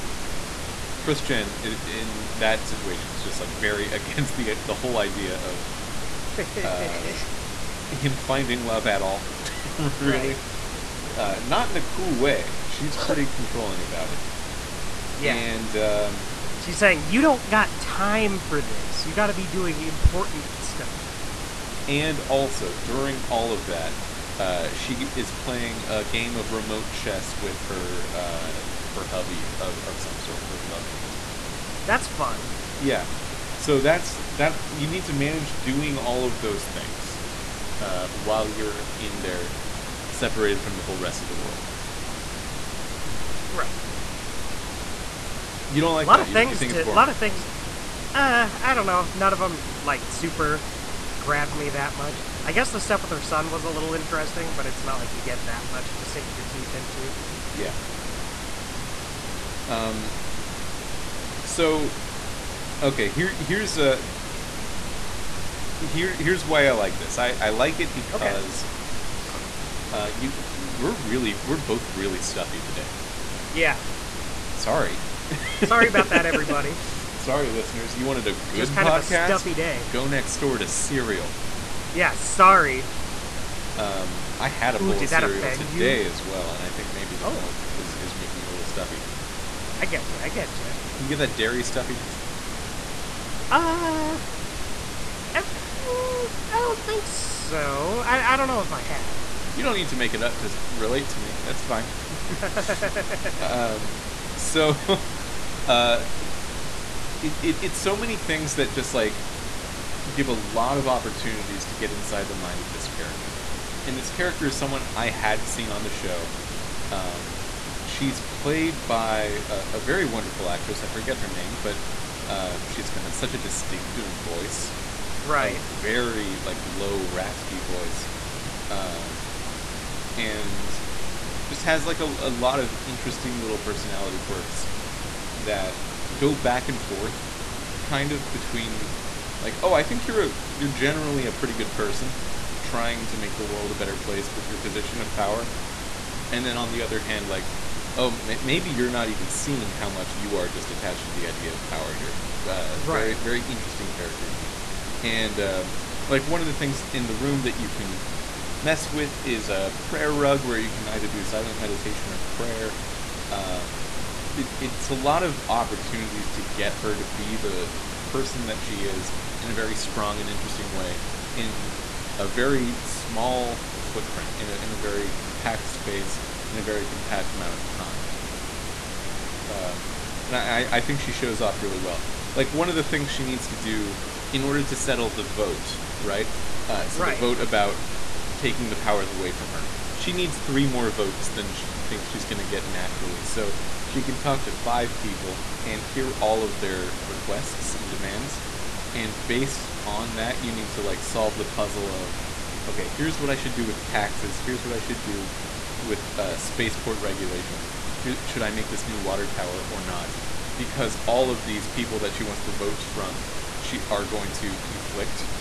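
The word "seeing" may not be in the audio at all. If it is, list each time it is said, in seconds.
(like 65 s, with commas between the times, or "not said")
149 s.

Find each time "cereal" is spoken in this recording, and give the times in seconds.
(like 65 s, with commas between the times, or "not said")
80 s, 85 s.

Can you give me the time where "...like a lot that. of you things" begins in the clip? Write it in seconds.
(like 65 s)
45 s.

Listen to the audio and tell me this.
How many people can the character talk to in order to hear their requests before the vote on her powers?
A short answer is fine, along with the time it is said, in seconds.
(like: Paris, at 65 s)
5, at 194 s.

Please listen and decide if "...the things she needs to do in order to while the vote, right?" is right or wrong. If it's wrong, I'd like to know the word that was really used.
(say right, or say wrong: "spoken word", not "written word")
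wrong: "settle", not "while".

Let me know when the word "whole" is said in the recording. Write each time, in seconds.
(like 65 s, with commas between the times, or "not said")
4 s, 40 s.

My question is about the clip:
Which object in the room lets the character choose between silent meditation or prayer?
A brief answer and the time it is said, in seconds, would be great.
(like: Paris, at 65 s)
prayer rug, at 159 s.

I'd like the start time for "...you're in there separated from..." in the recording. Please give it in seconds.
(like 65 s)
38 s.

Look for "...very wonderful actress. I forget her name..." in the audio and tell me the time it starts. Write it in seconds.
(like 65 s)
119 s.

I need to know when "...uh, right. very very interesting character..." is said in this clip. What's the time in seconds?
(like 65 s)
152 s.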